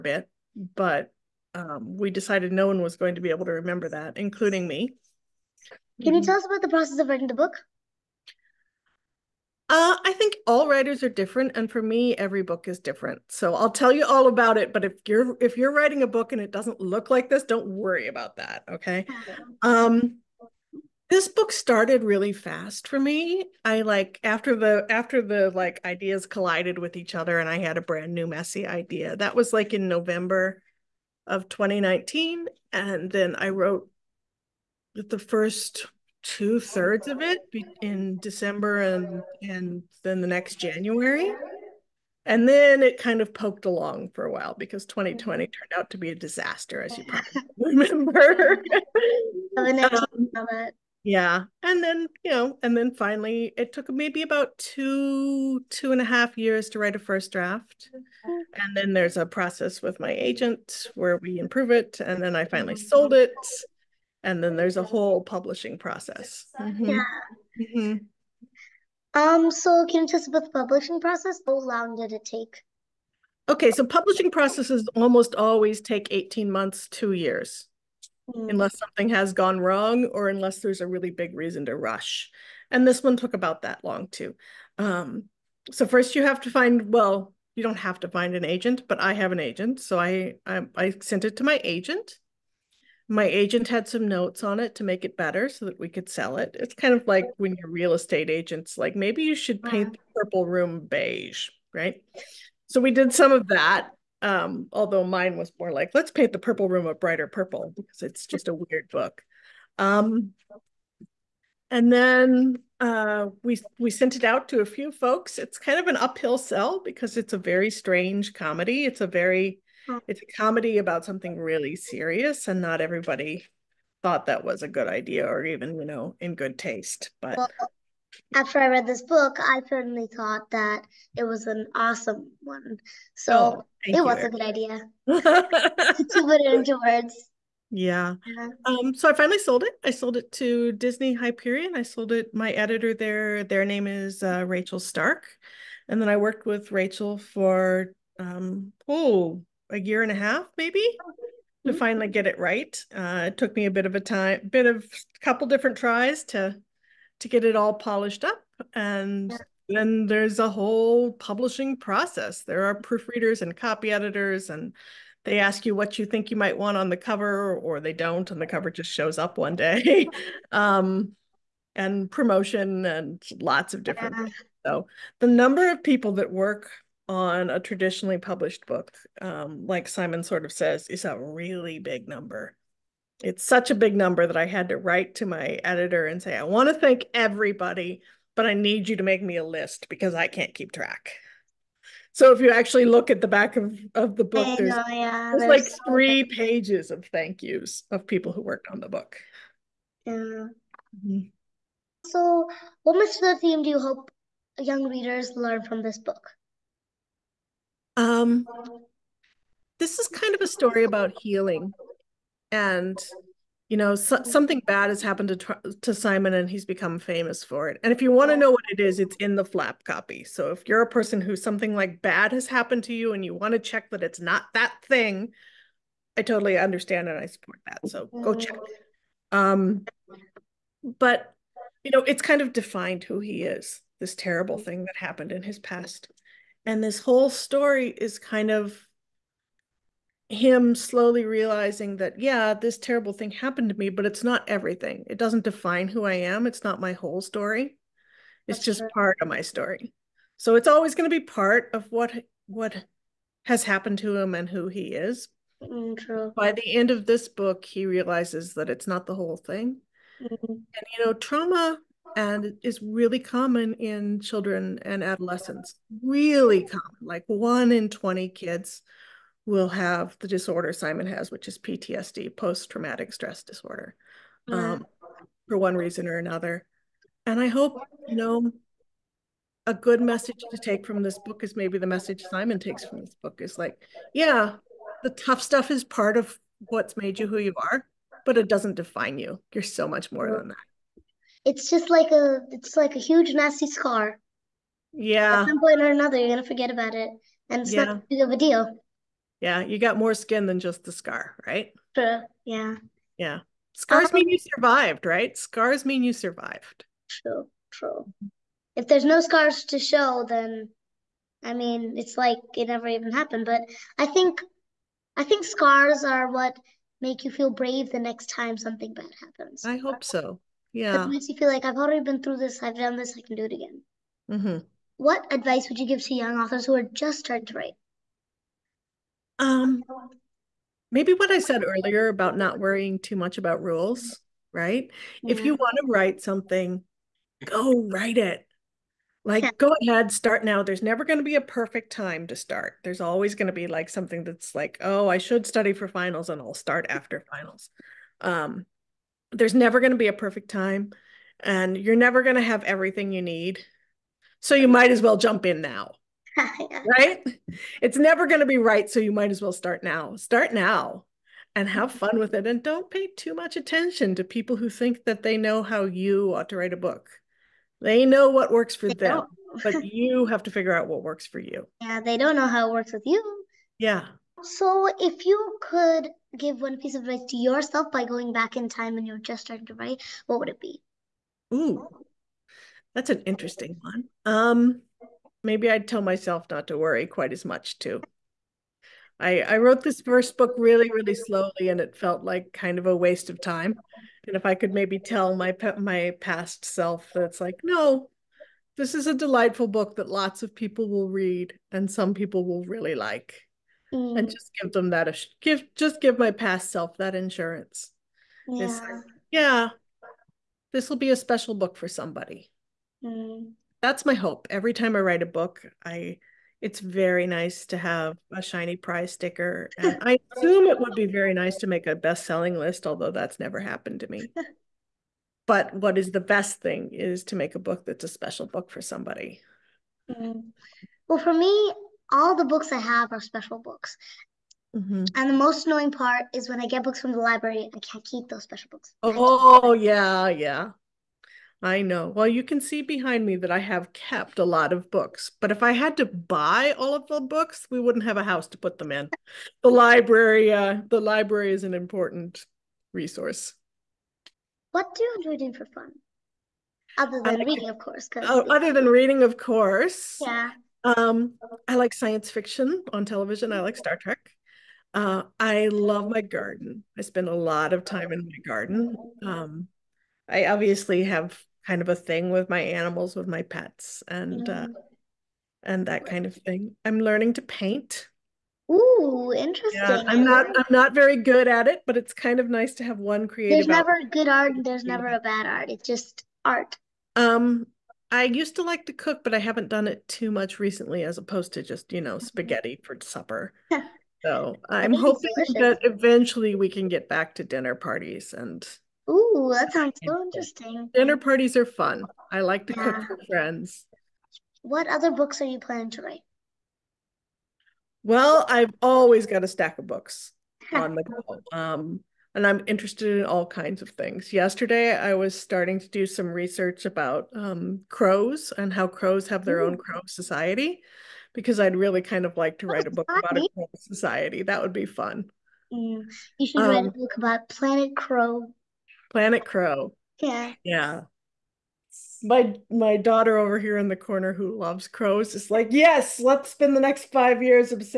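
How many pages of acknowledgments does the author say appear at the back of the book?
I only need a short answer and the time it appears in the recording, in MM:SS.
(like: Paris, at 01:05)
3, at 03:15.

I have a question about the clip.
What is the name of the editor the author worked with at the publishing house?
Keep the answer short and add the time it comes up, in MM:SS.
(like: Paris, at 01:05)
Rachel Stark, at 02:24.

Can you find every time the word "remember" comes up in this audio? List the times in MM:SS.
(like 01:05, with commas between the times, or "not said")
00:03, 00:47.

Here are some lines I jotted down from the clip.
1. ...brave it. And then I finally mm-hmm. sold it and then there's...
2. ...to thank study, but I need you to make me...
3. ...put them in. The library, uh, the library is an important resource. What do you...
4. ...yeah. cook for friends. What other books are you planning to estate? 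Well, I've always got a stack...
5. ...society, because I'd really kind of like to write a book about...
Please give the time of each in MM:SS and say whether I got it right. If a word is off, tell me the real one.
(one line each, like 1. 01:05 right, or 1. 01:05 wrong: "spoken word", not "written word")
1. 01:01 wrong: "improve", not "brave"
2. 03:06 wrong: "everybody", not "study"
3. 07:28 right
4. 08:22 wrong: "write", not "estate"
5. 08:40 right.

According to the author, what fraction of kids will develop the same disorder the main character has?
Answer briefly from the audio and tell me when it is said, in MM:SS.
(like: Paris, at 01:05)
1 in 20, at 04:27.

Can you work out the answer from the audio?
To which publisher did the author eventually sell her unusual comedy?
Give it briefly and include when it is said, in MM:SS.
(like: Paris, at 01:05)
Disney Hyperion, at 02:20.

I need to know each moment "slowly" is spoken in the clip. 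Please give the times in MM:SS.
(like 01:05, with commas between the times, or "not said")
04:00, 06:31.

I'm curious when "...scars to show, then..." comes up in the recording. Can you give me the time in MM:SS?
05:09.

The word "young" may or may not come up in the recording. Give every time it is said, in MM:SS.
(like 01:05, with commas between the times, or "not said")
03:24, 05:26.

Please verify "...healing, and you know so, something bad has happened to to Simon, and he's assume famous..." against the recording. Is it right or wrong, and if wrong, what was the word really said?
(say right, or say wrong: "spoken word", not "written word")
wrong: "become", not "assume".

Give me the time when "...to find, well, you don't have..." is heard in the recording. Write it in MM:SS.
01:26.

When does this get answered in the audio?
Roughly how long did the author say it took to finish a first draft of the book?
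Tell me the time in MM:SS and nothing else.
00:55.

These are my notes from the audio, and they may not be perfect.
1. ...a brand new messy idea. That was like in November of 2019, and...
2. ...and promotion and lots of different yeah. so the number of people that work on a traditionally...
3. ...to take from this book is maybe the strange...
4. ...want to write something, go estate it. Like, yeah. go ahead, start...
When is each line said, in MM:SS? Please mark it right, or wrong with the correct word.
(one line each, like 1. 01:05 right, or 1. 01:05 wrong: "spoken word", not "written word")
1. 00:27 right
2. 02:51 right
3. 04:40 wrong: "message", not "strange"
4. 05:35 wrong: "write", not "estate".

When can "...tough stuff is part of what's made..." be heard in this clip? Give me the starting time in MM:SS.
04:45.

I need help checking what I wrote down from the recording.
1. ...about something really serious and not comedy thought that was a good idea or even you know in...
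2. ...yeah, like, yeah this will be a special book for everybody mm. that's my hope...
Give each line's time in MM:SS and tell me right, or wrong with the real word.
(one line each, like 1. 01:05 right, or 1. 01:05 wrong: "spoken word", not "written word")
1. 02:00 wrong: "everybody", not "comedy"
2. 06:48 wrong: "somebody", not "everybody".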